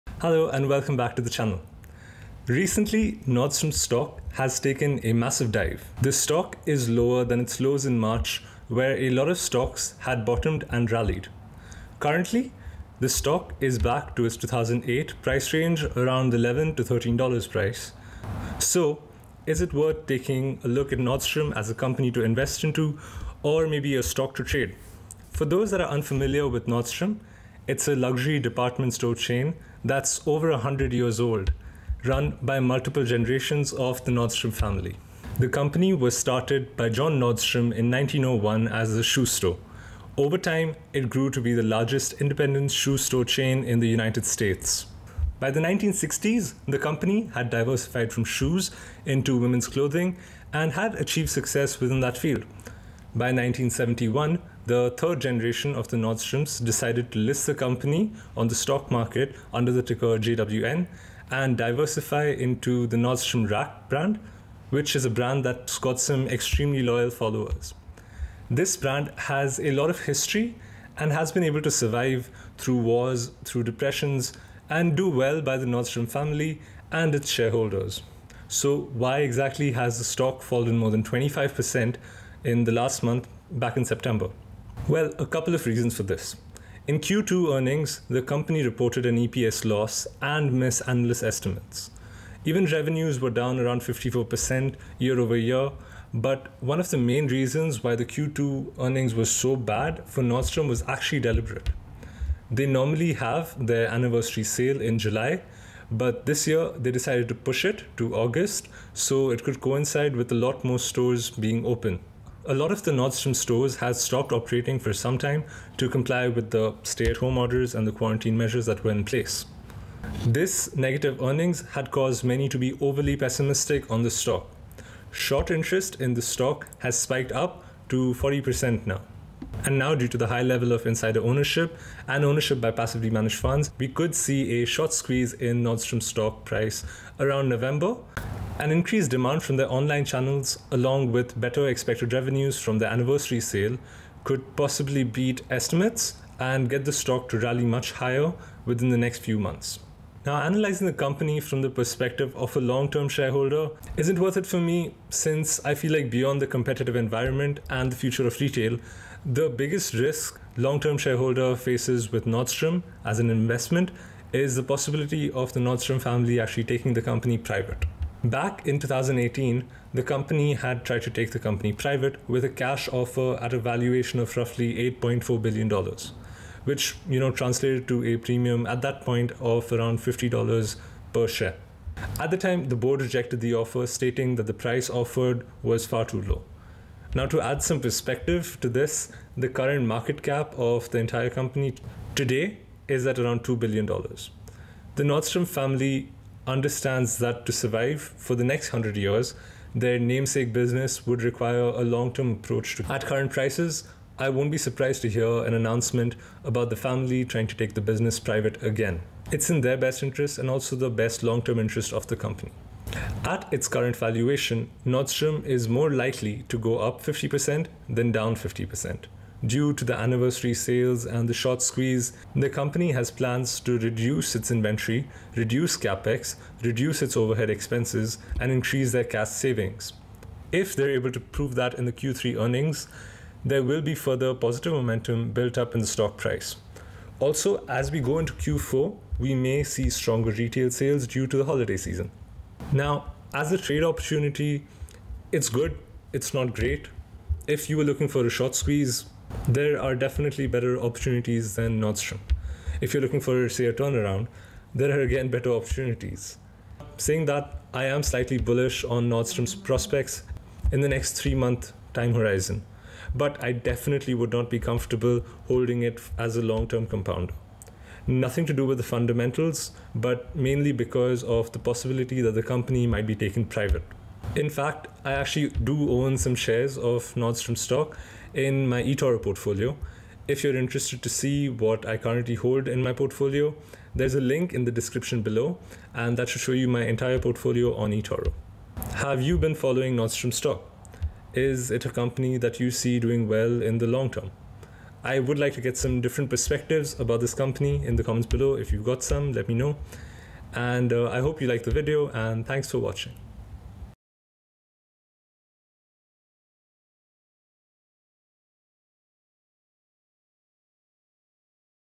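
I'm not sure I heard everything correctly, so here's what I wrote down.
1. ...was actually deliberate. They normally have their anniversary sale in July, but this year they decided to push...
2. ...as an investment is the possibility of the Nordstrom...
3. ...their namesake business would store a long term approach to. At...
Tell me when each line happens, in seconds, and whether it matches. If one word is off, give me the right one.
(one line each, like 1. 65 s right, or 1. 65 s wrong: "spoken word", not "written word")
1. 100 s right
2. 163 s right
3. 199 s wrong: "require", not "store".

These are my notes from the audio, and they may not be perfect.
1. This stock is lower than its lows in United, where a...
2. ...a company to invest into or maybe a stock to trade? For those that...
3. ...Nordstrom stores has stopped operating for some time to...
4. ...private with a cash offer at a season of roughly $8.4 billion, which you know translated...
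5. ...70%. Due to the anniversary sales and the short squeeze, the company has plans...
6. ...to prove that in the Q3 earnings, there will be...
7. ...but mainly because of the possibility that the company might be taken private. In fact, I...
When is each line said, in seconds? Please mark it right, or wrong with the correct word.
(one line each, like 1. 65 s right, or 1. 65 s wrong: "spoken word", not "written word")
1. 5 s wrong: "March", not "United"
2. 21 s right
3. 112 s right
4. 171 s wrong: "valuation", not "season"
5. 218 s wrong: "50", not "70"
6. 231 s right
7. 269 s right.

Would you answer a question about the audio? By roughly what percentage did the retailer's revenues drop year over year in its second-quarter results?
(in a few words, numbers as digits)
54%.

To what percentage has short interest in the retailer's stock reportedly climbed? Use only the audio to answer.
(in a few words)
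40%.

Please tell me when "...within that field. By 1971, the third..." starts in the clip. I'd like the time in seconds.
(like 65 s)
51 s.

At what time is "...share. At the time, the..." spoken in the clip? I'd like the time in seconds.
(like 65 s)
181 s.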